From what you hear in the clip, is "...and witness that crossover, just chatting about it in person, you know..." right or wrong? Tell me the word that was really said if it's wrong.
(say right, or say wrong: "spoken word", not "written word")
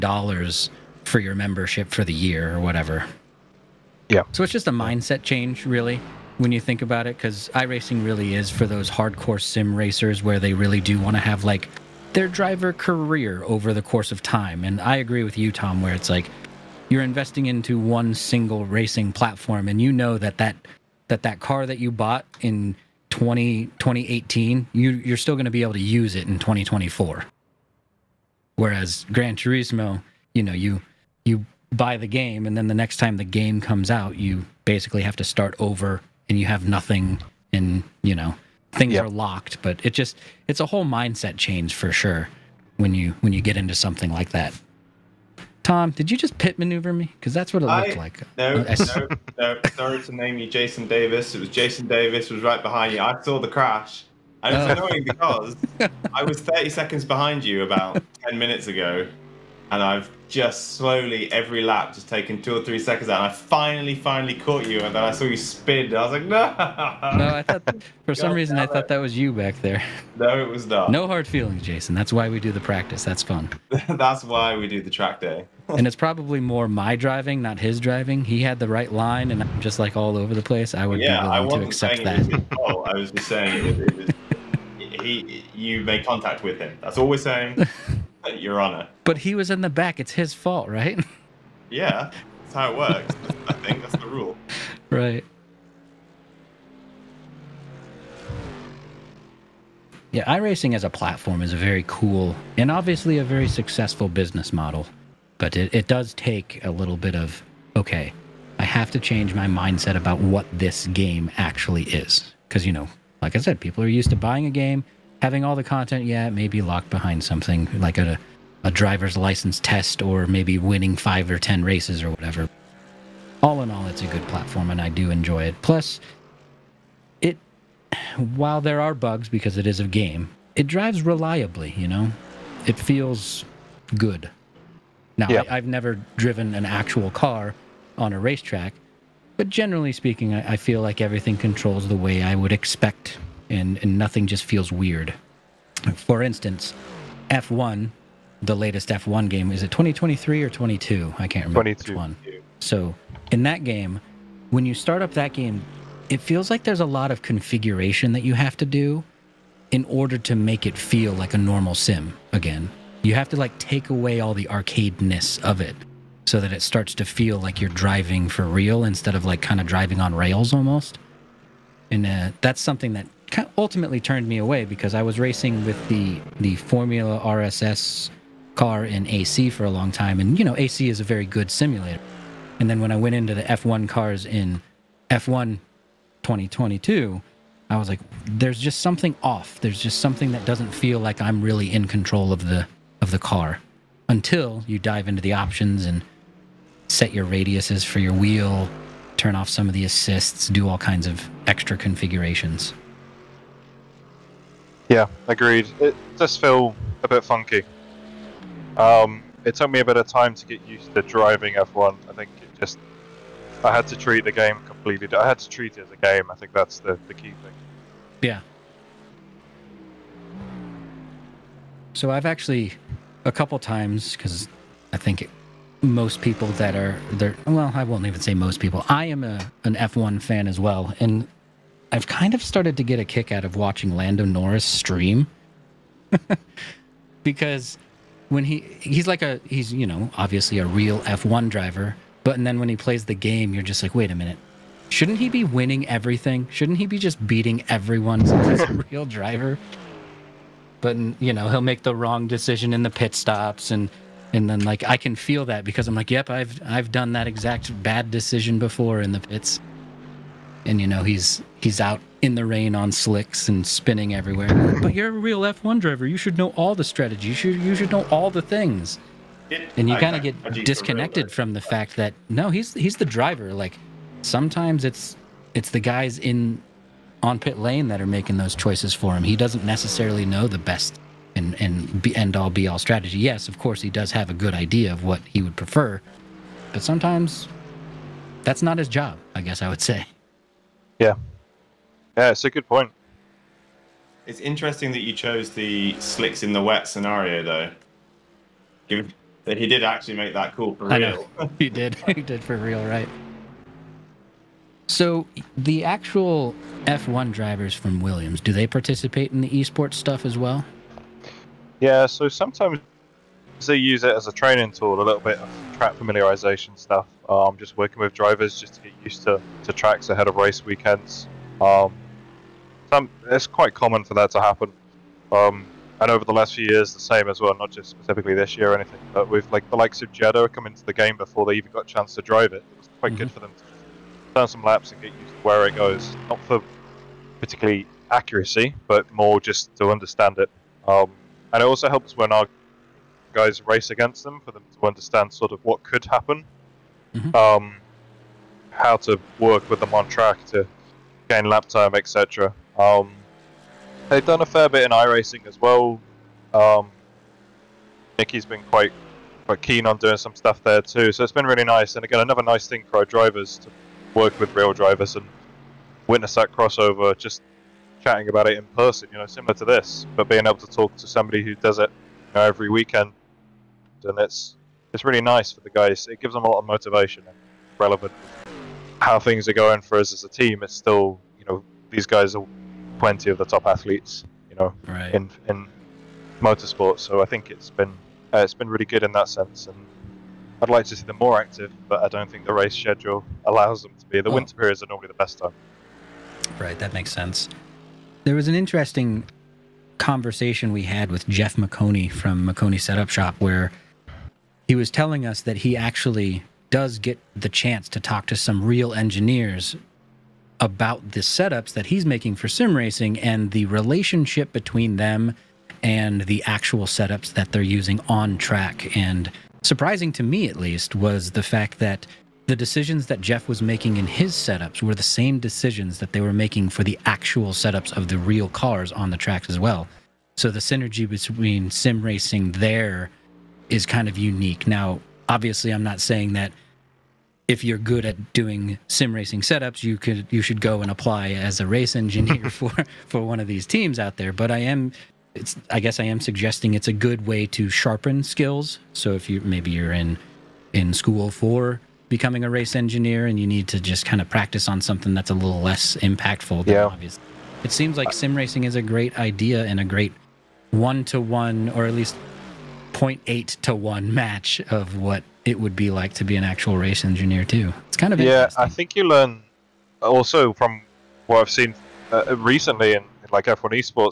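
right.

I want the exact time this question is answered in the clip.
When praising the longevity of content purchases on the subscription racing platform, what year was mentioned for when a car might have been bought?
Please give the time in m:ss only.
0:23.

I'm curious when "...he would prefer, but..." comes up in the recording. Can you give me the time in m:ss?
4:45.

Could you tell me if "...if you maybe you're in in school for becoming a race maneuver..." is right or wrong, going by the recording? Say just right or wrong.
wrong.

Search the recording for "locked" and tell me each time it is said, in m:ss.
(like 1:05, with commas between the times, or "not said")
0:39, 1:56.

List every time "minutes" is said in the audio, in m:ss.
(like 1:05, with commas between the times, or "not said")
0:58, 4:04.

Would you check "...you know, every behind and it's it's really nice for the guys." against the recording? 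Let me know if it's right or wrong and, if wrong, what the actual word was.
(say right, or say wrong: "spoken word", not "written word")
wrong: "weekend", not "behind".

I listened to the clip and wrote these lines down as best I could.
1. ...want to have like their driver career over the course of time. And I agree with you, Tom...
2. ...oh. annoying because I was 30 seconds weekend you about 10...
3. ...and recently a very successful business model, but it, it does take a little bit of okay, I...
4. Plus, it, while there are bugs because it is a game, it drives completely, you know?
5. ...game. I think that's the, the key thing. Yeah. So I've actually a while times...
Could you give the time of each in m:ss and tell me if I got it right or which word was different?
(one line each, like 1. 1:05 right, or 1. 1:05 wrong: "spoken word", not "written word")
1. 0:10 right
2. 0:54 wrong: "behind", not "weekend"
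3. 1:42 wrong: "obviously", not "recently"
4. 2:05 wrong: "reliably", not "completely"
5. 3:35 wrong: "couple", not "while".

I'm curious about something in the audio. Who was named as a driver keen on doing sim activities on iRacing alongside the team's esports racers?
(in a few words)
Nikki.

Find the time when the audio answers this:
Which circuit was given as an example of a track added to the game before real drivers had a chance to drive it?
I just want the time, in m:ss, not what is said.
5:30.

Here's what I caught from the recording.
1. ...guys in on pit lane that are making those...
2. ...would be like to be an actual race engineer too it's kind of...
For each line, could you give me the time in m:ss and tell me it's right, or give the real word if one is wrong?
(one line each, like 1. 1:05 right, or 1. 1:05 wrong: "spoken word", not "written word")
1. 4:35 right
2. 7:45 right.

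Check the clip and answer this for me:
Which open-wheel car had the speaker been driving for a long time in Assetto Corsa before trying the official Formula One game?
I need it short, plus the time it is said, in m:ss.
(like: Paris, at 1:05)
Formula RSS, at 2:56.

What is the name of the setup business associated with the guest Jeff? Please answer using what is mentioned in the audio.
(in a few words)
Maconi Setup Shop.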